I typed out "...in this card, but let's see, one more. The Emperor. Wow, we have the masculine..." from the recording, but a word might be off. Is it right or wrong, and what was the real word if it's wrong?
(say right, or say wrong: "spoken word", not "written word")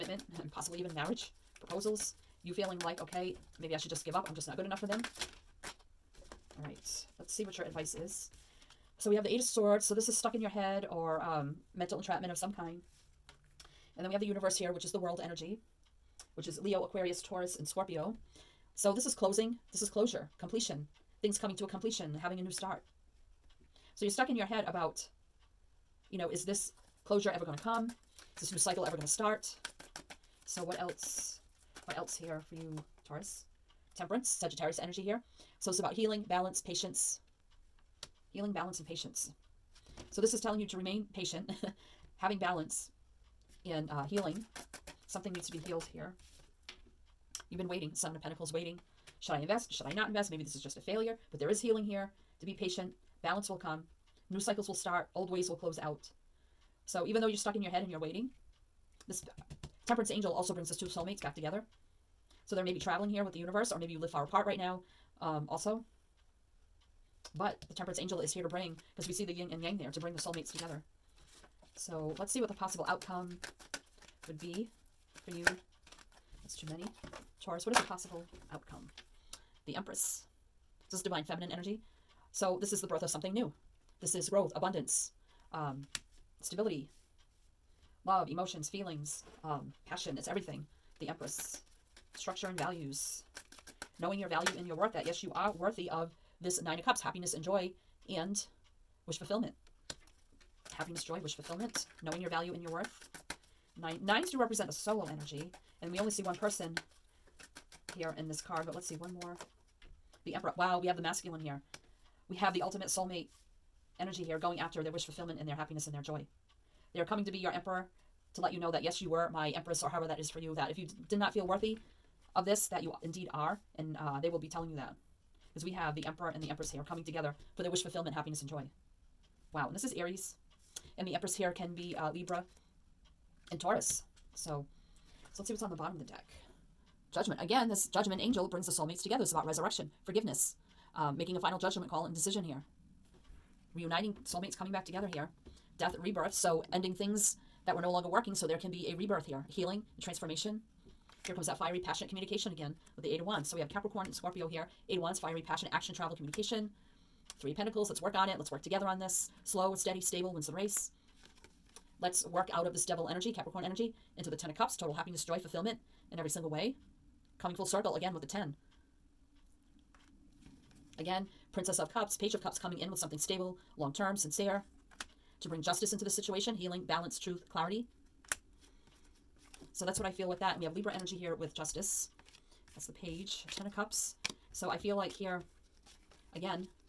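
right.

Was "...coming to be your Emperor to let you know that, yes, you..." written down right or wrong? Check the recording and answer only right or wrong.
right.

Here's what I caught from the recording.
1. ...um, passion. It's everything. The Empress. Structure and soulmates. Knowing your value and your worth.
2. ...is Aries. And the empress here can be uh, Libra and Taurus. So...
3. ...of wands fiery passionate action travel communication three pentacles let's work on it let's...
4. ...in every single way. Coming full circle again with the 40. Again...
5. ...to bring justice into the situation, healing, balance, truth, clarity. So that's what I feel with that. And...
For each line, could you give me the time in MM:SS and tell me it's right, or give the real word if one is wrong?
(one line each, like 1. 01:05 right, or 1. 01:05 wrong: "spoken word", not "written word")
1. 01:29 wrong: "values", not "soulmates"
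2. 02:09 right
3. 02:34 right
4. 02:46 wrong: "10", not "40"
5. 02:55 right.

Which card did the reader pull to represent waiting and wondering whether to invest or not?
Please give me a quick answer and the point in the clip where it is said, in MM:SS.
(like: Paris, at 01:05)
Seven of Pentacles, at 00:47.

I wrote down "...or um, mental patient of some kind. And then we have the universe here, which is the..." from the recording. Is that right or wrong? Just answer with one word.
wrong.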